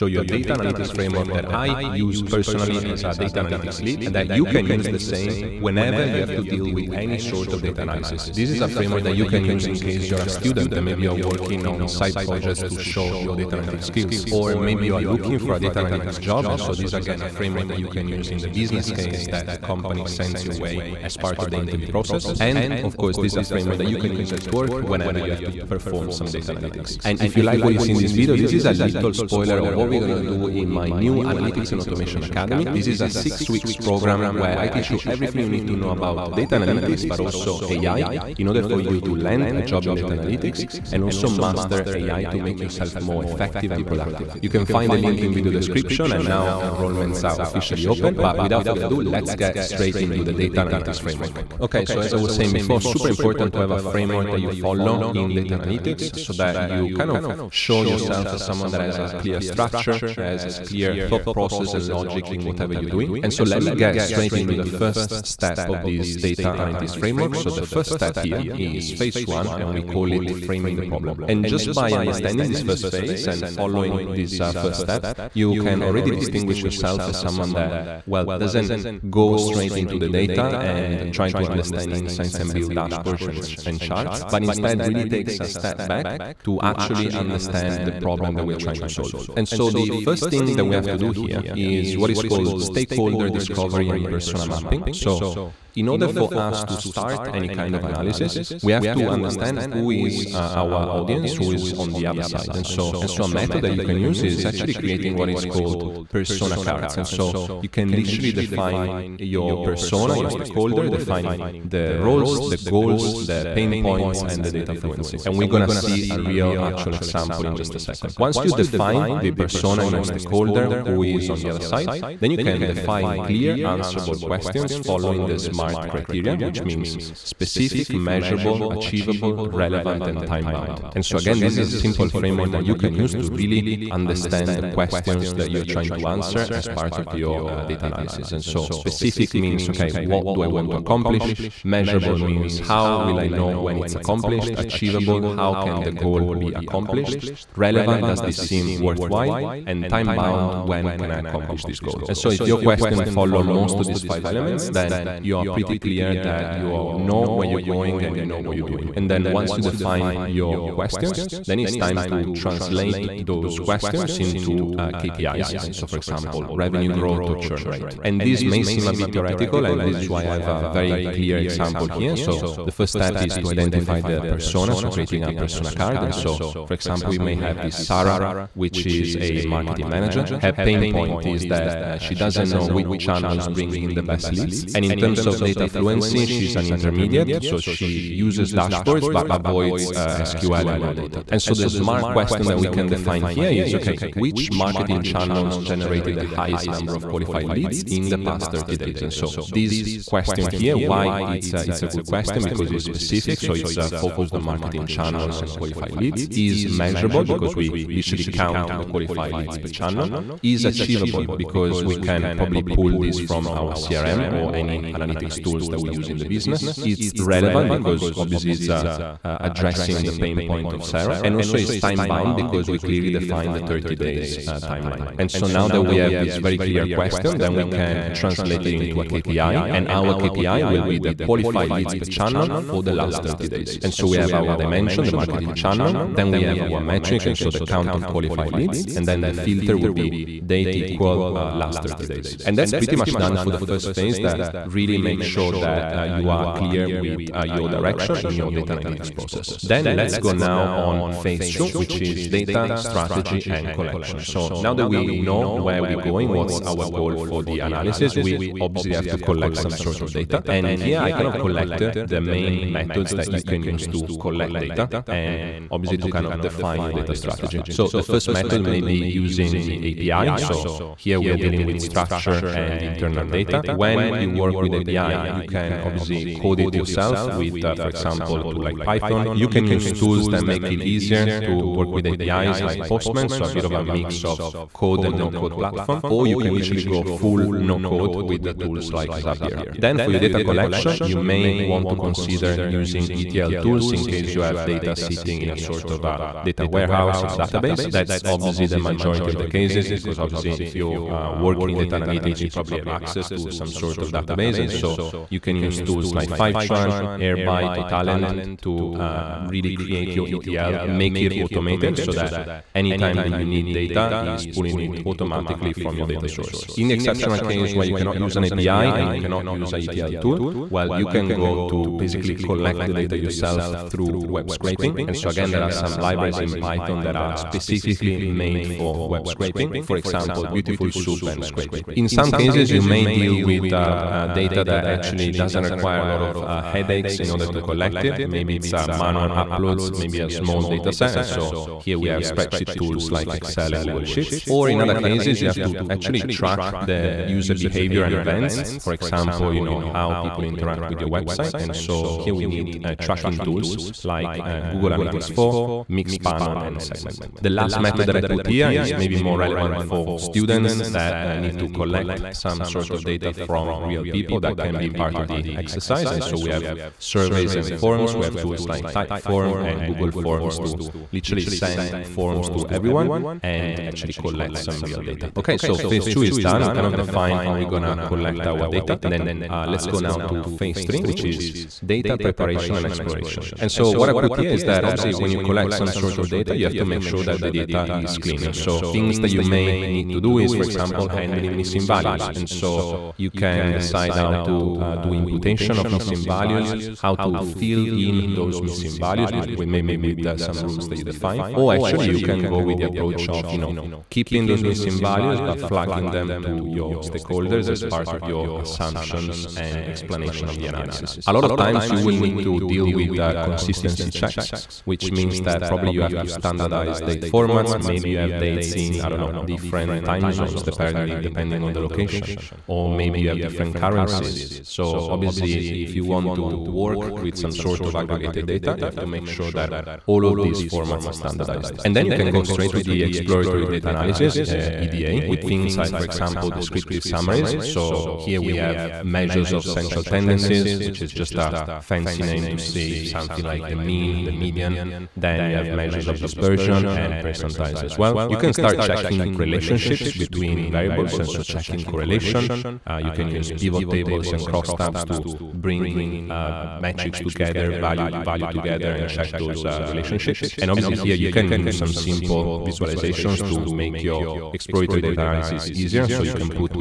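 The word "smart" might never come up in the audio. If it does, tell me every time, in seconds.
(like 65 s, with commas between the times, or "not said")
125 s, 191 s.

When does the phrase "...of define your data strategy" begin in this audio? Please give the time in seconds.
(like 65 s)
266 s.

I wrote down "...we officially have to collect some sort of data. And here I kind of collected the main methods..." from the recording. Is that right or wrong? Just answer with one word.
wrong.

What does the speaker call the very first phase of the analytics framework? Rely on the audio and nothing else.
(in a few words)
Framing the problem.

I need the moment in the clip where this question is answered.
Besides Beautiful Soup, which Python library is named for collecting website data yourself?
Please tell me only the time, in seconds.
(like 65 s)
331 s.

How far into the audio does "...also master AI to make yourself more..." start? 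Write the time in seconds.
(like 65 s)
41 s.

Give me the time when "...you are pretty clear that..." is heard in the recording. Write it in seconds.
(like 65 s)
155 s.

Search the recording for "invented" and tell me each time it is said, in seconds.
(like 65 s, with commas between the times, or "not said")
not said.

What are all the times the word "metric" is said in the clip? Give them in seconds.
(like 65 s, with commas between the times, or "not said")
236 s, 456 s.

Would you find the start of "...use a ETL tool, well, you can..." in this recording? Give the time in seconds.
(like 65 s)
319 s.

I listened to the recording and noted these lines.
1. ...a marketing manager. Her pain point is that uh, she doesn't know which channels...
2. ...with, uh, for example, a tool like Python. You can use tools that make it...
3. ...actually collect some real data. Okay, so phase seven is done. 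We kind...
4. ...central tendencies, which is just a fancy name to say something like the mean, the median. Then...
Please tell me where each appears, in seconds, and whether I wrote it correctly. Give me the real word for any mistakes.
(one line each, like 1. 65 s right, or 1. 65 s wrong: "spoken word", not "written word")
1. 179 s right
2. 277 s right
3. 373 s wrong: "two", not "seven"
4. 439 s right.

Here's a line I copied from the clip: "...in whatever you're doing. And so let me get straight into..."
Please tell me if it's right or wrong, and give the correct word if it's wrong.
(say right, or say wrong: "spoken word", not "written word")
right.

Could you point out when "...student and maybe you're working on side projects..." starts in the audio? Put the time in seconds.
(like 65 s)
10 s.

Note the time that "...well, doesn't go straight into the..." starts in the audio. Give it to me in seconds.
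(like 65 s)
78 s.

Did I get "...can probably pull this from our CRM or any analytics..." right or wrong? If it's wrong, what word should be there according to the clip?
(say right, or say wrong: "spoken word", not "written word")
right.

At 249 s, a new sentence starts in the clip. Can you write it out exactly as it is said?
Then let's go now on phase two, which is data, strategy, and collection.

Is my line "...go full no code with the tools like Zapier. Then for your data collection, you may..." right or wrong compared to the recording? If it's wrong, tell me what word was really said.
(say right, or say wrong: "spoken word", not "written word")
right.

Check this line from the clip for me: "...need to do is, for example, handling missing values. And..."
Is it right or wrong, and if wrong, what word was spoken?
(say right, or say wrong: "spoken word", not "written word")
right.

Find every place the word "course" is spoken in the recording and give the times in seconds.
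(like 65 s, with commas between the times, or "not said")
22 s.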